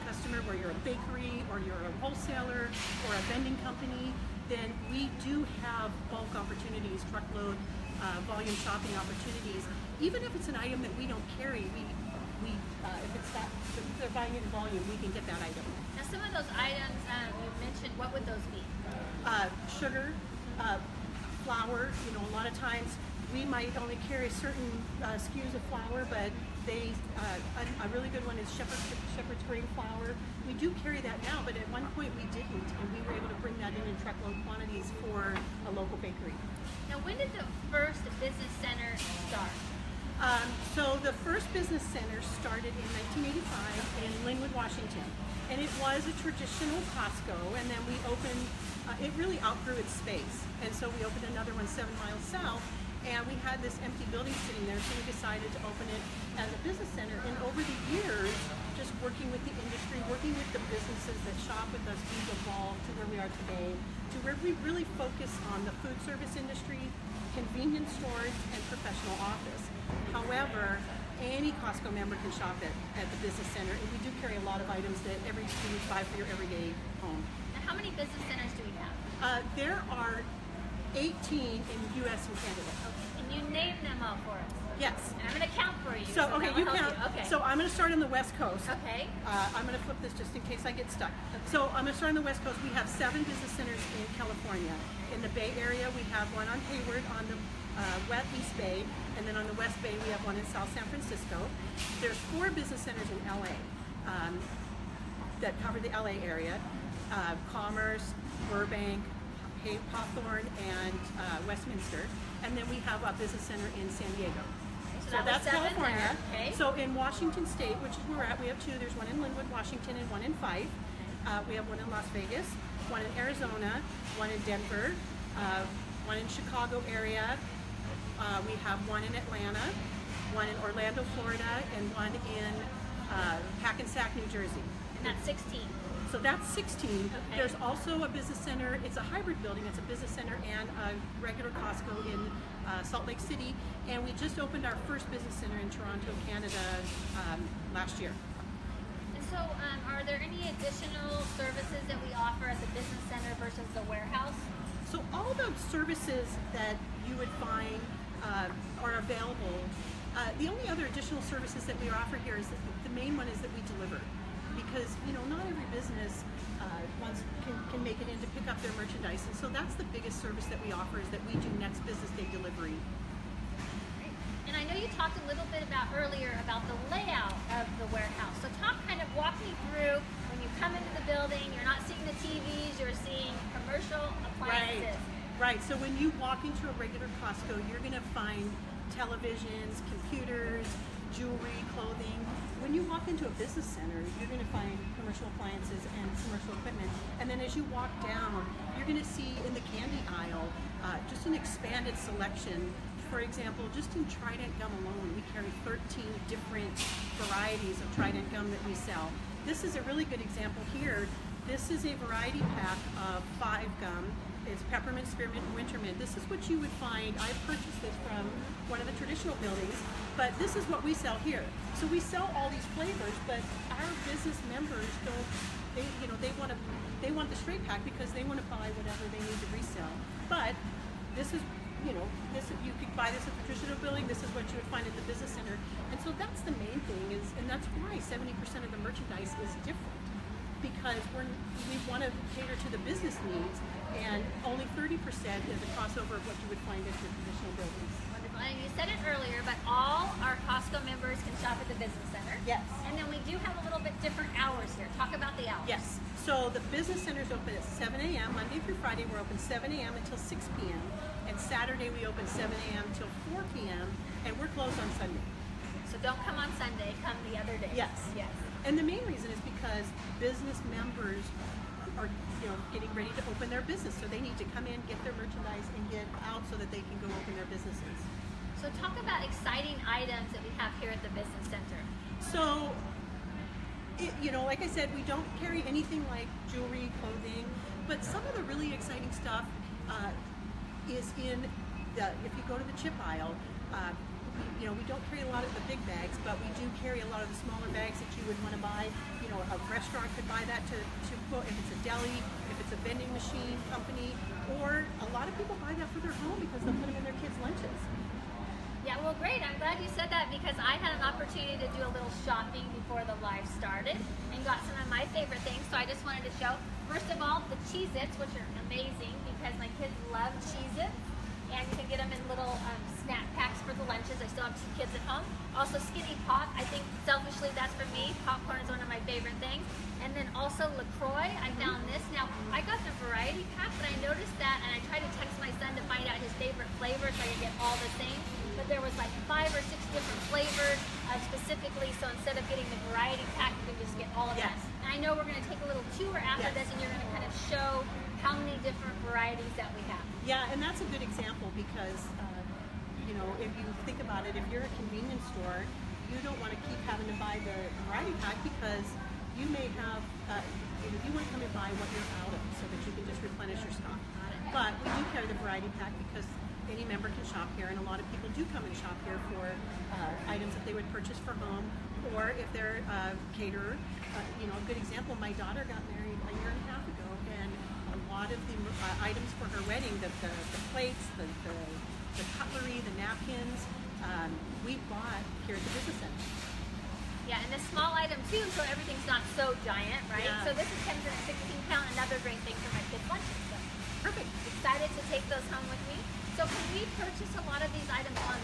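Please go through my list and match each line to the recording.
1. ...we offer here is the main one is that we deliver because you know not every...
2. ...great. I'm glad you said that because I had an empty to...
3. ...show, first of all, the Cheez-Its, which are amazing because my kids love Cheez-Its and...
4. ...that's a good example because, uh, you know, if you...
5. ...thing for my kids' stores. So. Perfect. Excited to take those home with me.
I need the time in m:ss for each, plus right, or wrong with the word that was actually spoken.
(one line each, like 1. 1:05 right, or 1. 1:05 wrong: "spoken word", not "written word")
1. 2:41 right
2. 5:09 wrong: "opportunity", not "empty"
3. 5:16 right
4. 5:50 right
5. 6:32 wrong: "lunches", not "stores".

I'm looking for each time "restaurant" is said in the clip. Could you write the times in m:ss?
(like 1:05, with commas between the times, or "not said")
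4:59.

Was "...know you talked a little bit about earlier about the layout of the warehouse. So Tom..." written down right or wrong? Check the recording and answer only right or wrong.
right.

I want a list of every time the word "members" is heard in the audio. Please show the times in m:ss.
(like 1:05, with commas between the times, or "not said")
1:11, 3:44, 4:10, 4:30, 6:06.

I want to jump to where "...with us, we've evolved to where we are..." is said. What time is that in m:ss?
1:01.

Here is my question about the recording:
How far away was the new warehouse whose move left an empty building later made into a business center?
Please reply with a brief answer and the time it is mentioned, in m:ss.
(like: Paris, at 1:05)
7, at 0:51.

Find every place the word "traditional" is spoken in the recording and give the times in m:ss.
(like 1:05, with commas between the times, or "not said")
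0:46, 3:38, 3:53, 4:07.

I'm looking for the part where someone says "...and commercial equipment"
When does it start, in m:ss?
3:15.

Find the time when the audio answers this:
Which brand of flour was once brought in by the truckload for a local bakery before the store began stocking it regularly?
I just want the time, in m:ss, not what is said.
0:29.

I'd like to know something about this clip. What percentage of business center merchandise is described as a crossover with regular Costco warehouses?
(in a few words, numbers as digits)
30%.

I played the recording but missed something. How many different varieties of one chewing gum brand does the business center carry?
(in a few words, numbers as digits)
13.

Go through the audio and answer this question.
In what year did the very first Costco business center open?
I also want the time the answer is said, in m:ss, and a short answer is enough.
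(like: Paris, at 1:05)
1985, at 0:43.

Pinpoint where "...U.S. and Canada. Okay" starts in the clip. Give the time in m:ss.
1:22.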